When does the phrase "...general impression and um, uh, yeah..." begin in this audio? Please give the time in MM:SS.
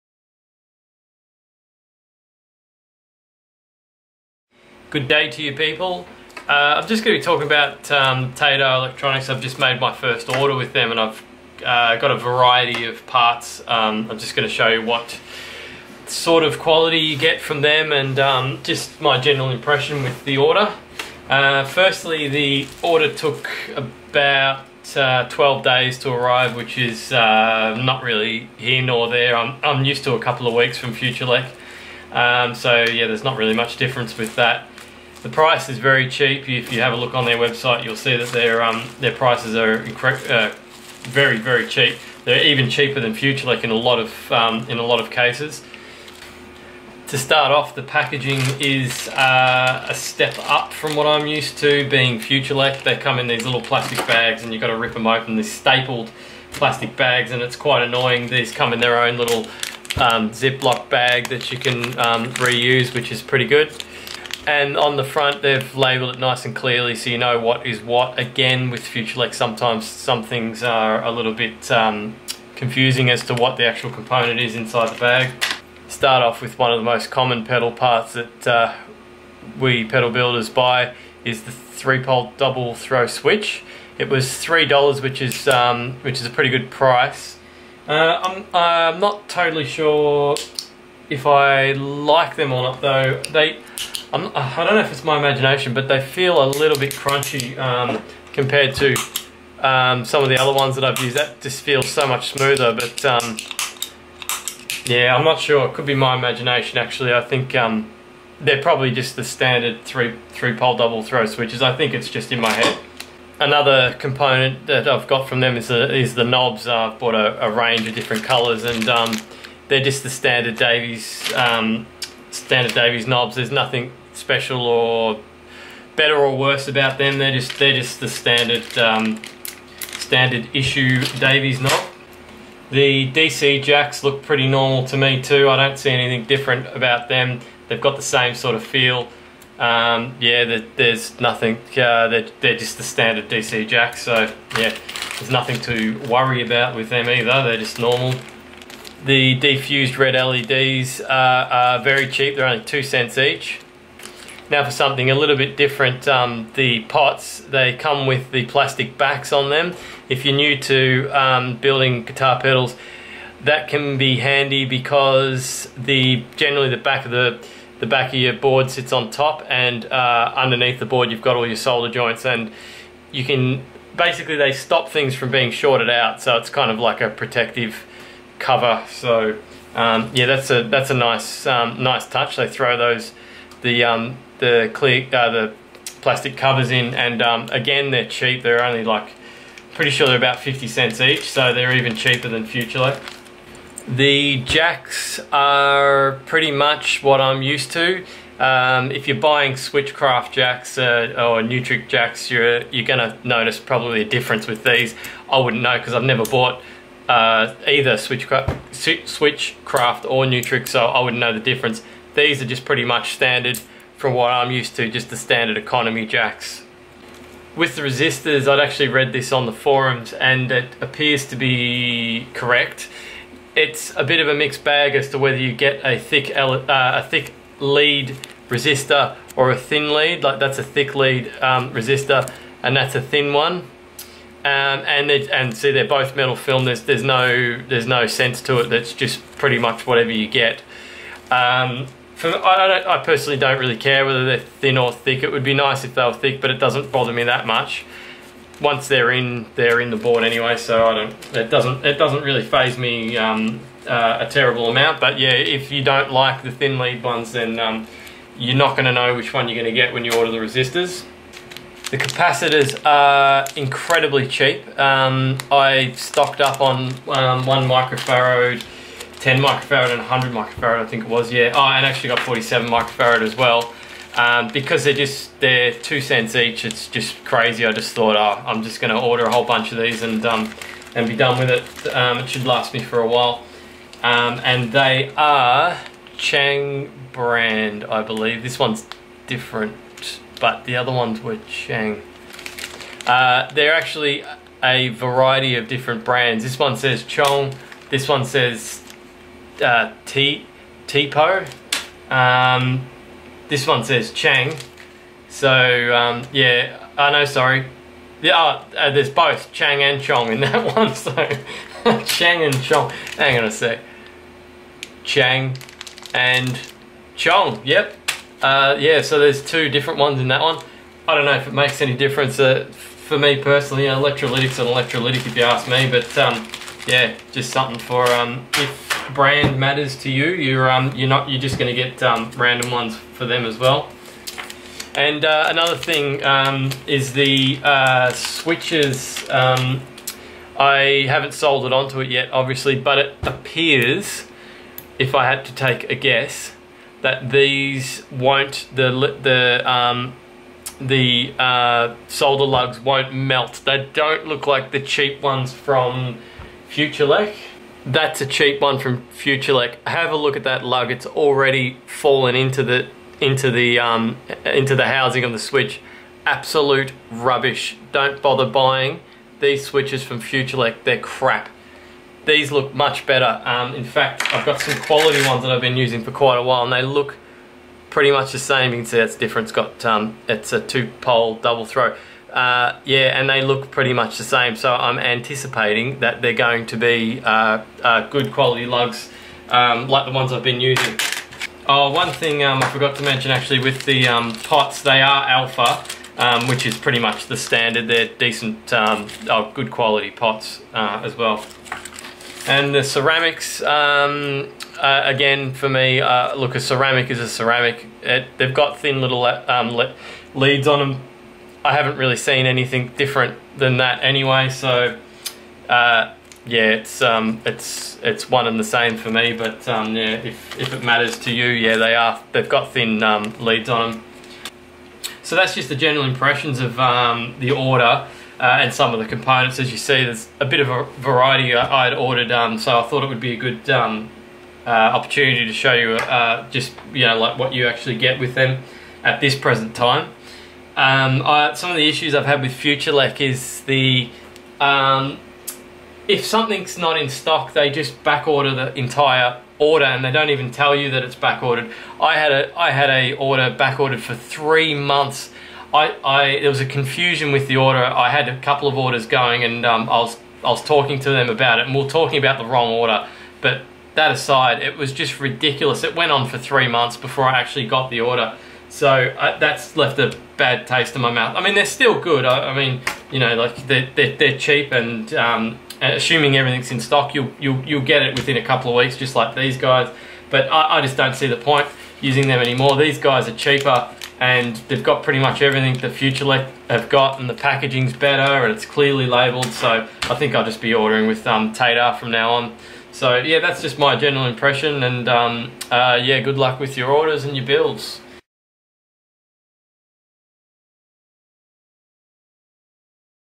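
08:13.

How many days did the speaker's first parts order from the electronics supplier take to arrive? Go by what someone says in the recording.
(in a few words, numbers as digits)
12 days.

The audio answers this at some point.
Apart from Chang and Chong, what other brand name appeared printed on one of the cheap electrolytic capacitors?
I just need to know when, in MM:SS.
05:00.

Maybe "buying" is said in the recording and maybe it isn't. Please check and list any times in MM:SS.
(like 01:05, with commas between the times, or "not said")
03:19, 06:08.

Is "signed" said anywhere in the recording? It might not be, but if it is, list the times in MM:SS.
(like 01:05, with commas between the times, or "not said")
not said.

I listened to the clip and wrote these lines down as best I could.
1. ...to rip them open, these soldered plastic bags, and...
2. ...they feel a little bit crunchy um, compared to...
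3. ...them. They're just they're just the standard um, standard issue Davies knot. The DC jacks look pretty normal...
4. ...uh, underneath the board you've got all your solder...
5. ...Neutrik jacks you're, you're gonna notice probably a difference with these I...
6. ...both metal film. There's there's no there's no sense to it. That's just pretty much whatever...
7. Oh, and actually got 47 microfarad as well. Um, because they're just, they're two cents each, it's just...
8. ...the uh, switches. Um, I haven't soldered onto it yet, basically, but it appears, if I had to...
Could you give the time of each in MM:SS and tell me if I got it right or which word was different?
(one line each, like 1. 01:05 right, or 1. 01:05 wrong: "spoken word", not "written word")
1. 00:54 wrong: "stapled", not "soldered"
2. 01:35 right
3. 02:06 right
4. 02:49 right
5. 03:21 right
6. 03:55 right
7. 04:31 right
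8. 05:37 wrong: "obviously", not "basically".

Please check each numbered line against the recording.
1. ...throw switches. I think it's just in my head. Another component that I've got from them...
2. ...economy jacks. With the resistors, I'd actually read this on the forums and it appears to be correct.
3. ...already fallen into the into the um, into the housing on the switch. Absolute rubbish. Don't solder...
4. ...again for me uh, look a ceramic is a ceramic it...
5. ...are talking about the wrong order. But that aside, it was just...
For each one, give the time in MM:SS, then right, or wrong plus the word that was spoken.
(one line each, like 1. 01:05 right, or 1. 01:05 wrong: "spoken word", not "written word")
1. 01:51 right
2. 03:35 right
3. 06:01 wrong: "bother", not "solder"
4. 06:45 right
5. 07:41 right.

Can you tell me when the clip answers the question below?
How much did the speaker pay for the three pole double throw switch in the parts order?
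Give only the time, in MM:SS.
01:24.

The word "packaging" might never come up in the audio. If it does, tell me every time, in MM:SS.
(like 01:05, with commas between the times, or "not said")
00:47, 08:07.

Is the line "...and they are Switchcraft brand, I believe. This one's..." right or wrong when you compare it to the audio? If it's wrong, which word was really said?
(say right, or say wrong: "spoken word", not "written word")
wrong: "Chang", not "Switchcraft".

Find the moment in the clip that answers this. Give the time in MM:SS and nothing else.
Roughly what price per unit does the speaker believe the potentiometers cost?
03:10.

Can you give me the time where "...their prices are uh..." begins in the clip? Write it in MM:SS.
00:38.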